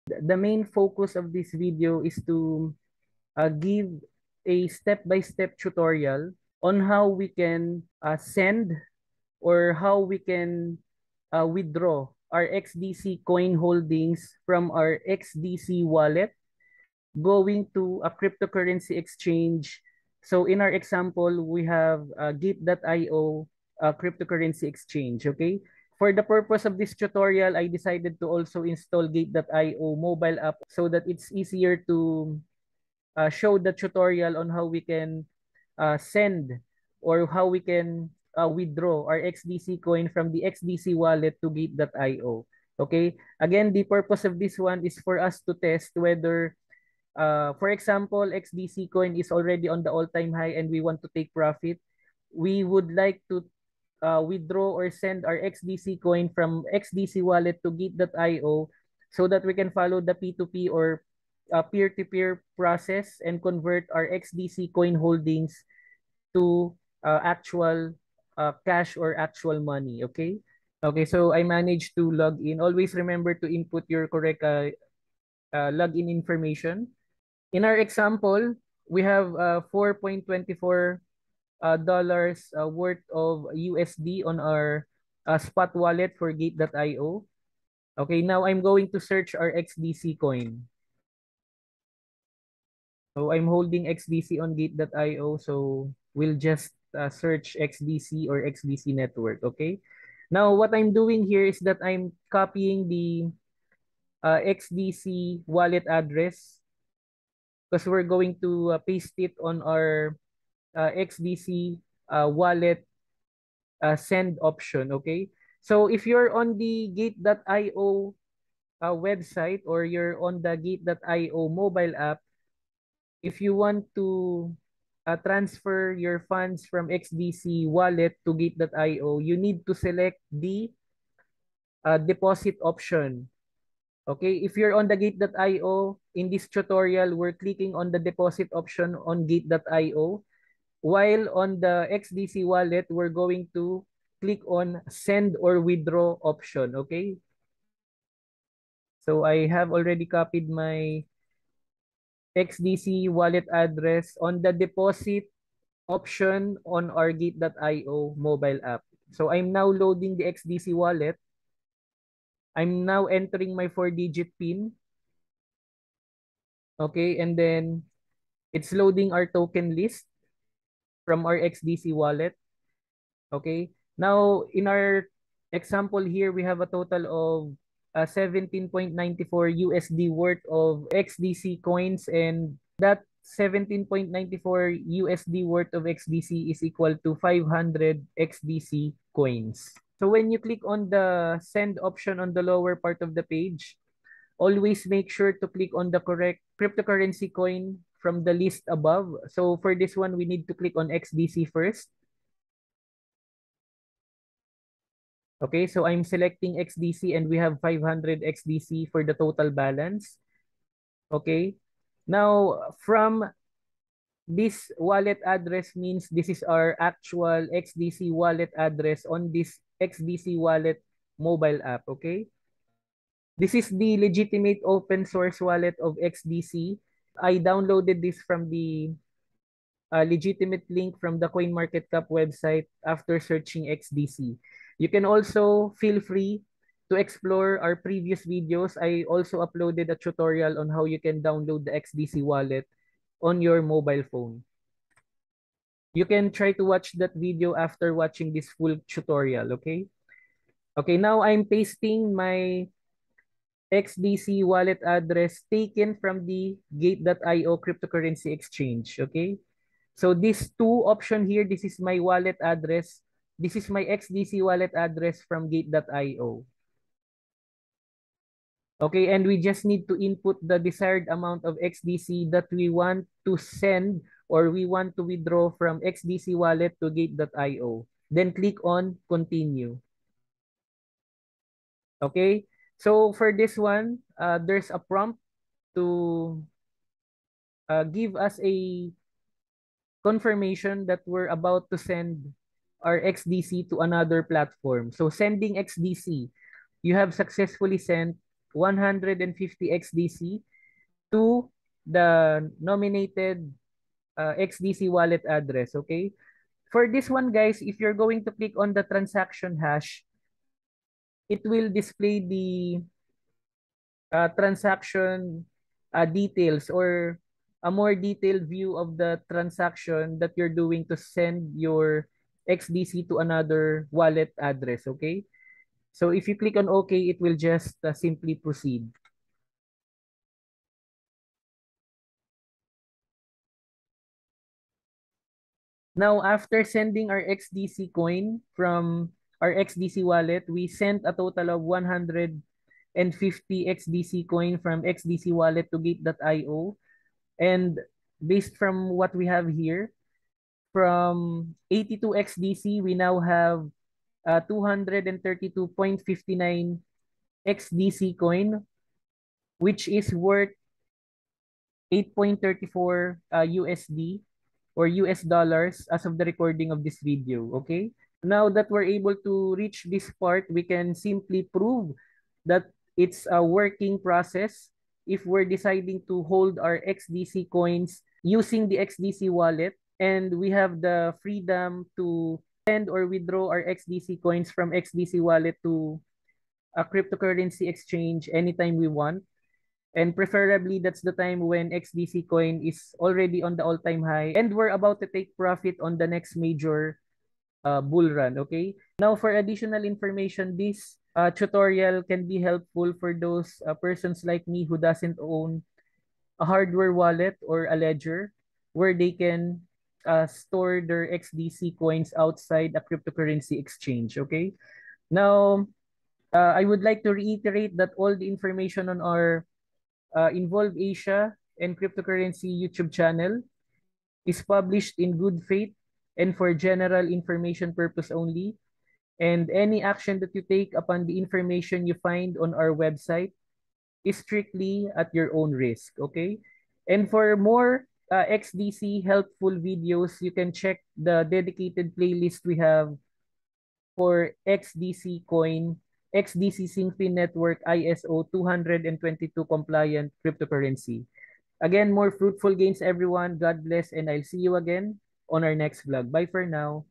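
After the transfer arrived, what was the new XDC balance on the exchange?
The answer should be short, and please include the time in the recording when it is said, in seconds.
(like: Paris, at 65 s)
232.59 XDC, at 354 s.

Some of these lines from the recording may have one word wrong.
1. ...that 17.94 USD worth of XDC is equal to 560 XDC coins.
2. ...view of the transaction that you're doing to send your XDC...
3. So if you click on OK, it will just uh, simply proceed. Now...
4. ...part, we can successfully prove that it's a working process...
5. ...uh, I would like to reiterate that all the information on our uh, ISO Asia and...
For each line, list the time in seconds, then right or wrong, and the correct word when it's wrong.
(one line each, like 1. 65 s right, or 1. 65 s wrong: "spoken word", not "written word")
1. 182 s wrong: "500", not "560"
2. 318 s right
3. 325 s right
4. 370 s wrong: "simply", not "successfully"
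5. 416 s wrong: "Involve", not "ISO".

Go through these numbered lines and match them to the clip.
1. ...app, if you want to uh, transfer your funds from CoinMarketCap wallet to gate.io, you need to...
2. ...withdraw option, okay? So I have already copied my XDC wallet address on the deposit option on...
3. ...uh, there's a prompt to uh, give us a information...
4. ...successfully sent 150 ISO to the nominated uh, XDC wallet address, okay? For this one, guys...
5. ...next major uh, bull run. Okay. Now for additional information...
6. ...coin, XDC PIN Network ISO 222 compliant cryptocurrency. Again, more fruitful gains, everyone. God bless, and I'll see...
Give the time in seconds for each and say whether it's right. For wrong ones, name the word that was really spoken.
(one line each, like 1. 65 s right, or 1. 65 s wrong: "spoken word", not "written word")
1. 121 s wrong: "XDC", not "CoinMarketCap"
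2. 145 s right
3. 284 s wrong: "confirmation", not "information"
4. 297 s wrong: "XDC", not "ISO"
5. 396 s right
6. 445 s wrong: "XinFin", not "PIN".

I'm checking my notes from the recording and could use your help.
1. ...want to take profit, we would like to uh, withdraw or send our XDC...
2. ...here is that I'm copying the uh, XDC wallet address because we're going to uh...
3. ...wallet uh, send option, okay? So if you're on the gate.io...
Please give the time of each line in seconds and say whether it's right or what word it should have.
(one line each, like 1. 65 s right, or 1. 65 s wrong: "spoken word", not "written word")
1. 50 s right
2. 101 s right
3. 112 s right.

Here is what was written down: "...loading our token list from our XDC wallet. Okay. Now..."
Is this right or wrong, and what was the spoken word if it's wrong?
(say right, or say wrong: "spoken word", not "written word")
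right.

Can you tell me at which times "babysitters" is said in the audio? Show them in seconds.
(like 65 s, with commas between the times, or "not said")
not said.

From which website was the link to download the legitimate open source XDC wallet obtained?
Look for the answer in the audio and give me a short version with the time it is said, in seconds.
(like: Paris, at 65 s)
CoinMarketCap, at 231 s.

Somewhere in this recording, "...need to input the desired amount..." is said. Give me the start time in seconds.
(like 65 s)
269 s.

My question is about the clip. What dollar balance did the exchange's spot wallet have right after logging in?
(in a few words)
4.24 dollars.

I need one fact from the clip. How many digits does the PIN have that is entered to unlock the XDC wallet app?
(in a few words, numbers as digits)
4.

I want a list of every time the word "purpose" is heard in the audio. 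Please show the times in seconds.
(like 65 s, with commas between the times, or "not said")
26 s, 43 s, 427 s.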